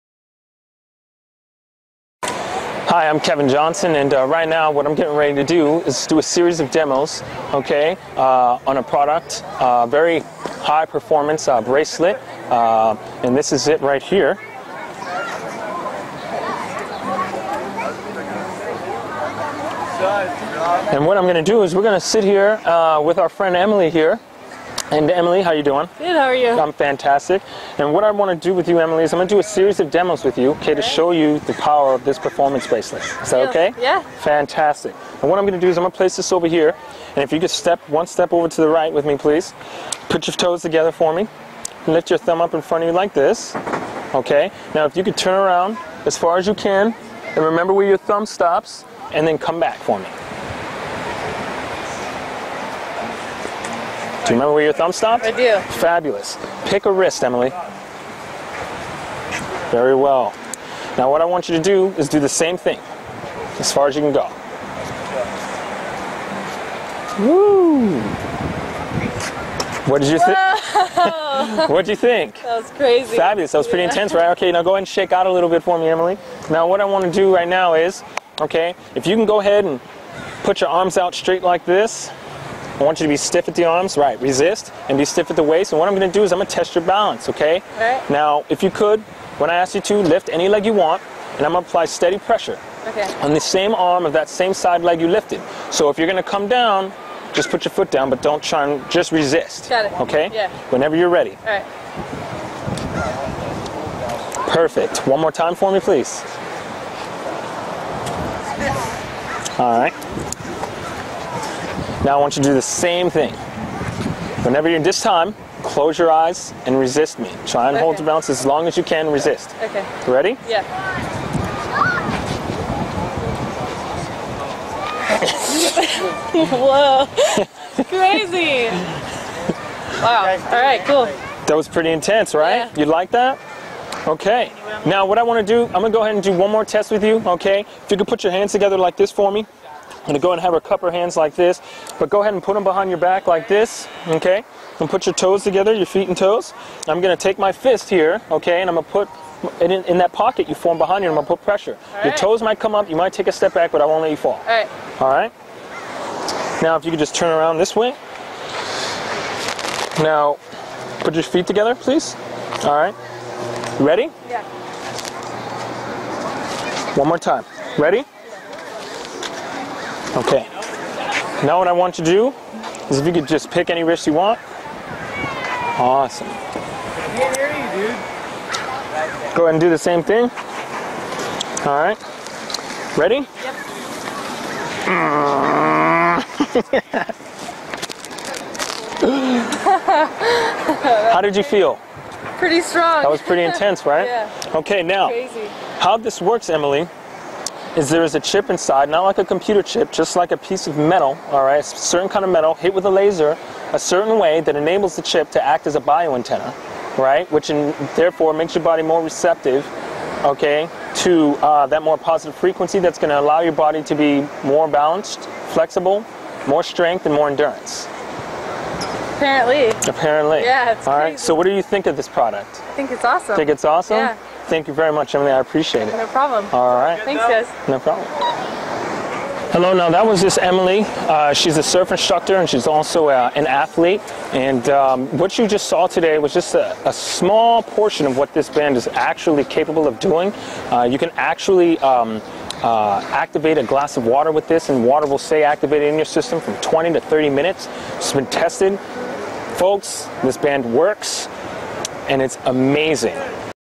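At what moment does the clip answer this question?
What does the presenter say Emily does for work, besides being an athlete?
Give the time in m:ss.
3:51.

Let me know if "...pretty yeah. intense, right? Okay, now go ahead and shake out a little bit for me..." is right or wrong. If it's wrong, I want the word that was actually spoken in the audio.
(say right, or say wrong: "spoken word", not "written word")
right.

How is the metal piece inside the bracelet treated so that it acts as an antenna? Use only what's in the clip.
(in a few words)
a laser.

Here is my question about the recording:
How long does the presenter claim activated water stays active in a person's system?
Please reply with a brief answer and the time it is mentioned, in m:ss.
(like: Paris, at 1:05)
20 to 30 minutes, at 4:06.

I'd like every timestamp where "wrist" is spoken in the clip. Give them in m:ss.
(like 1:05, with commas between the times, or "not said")
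0:56, 2:53.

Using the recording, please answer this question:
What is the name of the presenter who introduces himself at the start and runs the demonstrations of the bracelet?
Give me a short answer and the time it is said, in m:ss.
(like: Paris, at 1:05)
Kevin Johnson, at 0:03.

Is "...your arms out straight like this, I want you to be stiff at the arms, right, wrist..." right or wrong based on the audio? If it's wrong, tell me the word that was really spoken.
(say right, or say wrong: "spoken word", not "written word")
wrong: "resist", not "wrist".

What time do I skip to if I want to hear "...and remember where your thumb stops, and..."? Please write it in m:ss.
0:47.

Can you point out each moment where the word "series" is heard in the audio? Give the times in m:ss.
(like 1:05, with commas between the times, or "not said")
0:06, 0:29.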